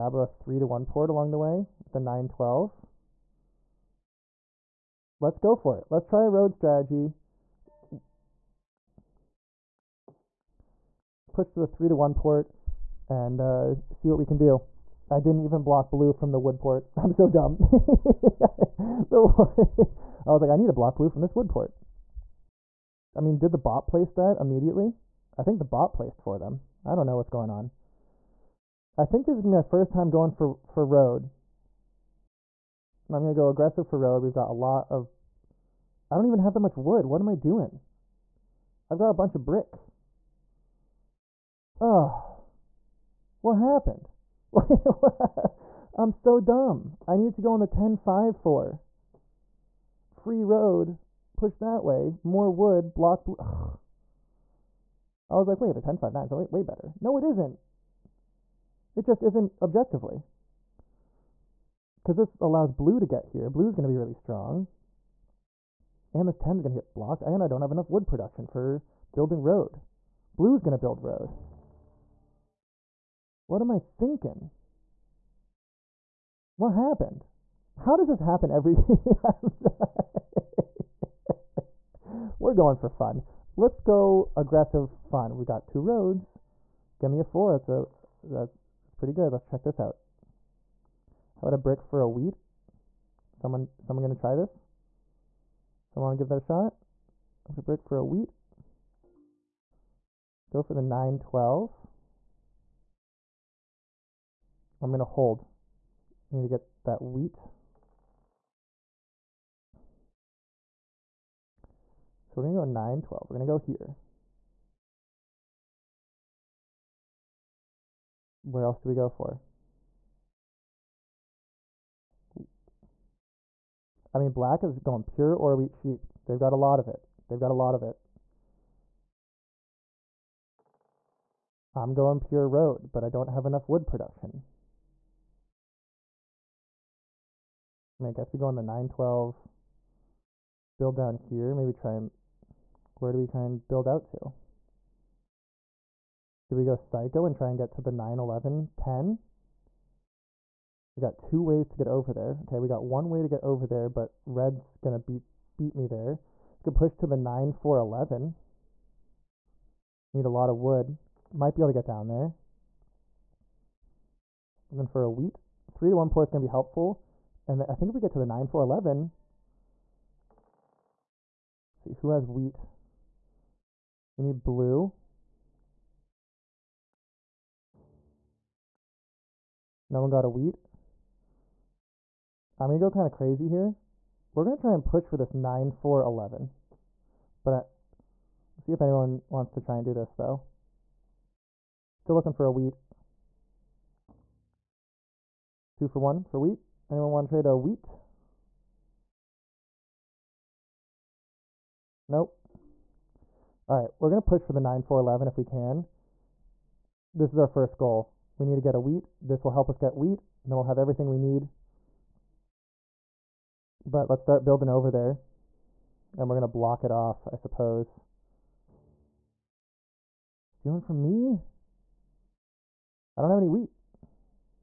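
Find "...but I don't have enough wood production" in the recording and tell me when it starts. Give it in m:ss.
2:12.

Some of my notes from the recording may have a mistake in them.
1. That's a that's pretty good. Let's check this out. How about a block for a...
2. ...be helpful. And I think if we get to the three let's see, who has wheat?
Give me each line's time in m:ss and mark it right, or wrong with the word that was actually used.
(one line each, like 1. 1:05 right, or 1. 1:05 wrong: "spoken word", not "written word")
1. 1:27 wrong: "brick", not "block"
2. 2:46 wrong: "nine", not "three".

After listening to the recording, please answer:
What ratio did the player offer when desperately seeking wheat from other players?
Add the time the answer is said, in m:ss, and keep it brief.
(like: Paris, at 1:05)
2 for 1, at 3:15.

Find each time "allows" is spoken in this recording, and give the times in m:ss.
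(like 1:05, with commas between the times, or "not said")
1:02.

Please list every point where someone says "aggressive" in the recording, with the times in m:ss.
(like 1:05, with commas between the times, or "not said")
0:33, 1:24.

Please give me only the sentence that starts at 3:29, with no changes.
This will help us get wheat, and then we'll have everything we need.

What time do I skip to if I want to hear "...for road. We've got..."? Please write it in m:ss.
0:33.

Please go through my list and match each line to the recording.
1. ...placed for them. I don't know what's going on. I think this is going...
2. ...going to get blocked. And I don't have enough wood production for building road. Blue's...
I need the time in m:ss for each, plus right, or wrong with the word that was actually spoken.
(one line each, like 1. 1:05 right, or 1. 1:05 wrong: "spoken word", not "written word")
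1. 0:25 right
2. 1:06 right.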